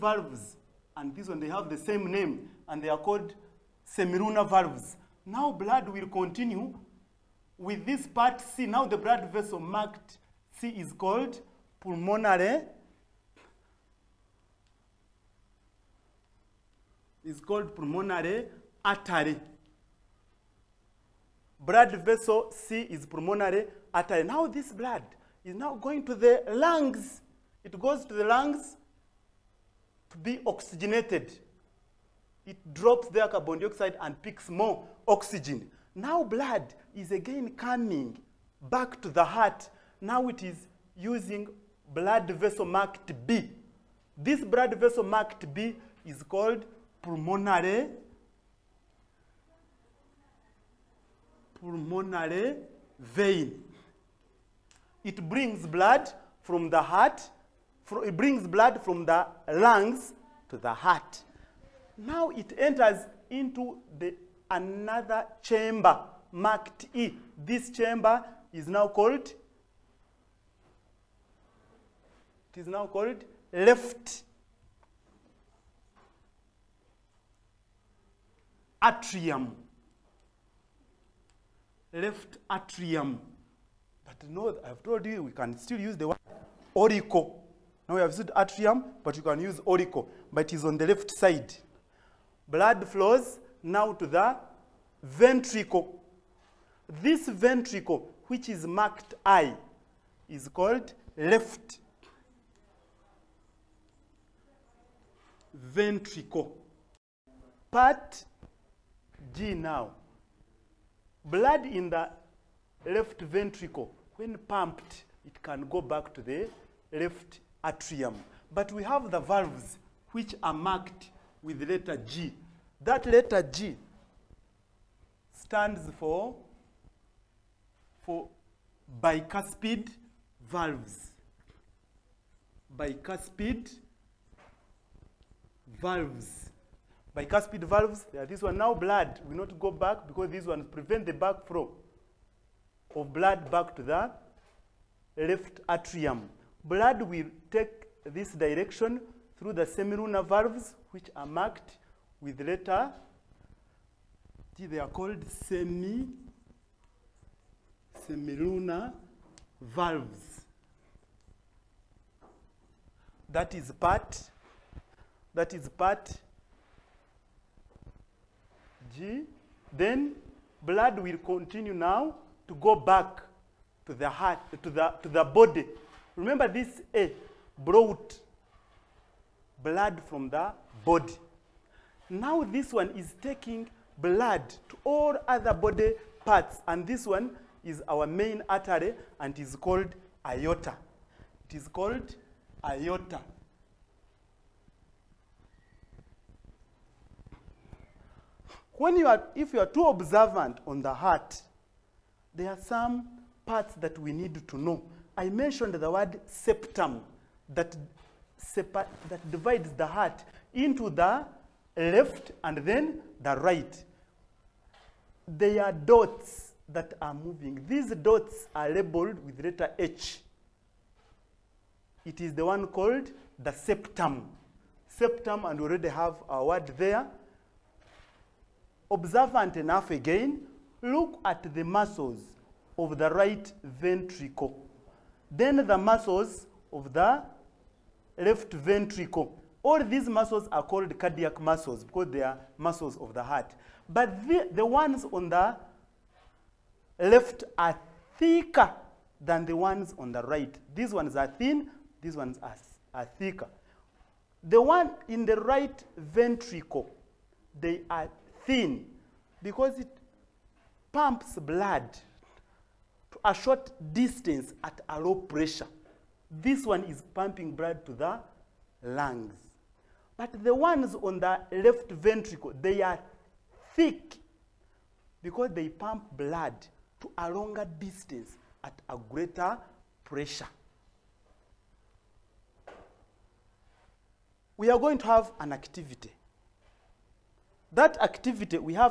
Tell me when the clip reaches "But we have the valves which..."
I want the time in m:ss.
1:58.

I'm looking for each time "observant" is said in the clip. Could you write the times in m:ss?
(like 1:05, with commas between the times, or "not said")
3:19, 3:48.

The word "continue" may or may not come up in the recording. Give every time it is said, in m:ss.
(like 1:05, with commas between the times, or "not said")
0:06, 2:51.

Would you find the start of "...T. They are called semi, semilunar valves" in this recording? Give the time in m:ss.
2:34.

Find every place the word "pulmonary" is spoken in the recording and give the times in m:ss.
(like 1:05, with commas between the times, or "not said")
0:11, 0:17, 0:23, 0:47, 0:51.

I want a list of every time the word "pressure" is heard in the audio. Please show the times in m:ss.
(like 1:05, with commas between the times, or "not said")
4:25, 4:40.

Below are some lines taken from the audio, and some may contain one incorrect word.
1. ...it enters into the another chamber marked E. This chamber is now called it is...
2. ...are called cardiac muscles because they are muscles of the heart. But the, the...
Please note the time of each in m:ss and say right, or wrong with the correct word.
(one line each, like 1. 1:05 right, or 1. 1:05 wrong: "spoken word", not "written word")
1. 1:02 right
2. 4:00 right.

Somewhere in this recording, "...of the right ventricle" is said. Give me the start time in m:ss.
3:52.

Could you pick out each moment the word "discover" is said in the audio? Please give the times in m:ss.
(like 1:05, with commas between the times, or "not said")
not said.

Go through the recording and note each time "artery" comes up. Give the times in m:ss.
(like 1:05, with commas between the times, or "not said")
0:18, 0:23, 3:08.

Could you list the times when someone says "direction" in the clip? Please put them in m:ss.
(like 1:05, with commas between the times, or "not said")
2:28.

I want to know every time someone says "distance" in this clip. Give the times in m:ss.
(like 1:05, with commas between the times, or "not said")
4:23, 4:37.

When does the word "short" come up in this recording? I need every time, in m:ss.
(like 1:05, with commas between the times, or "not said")
4:23.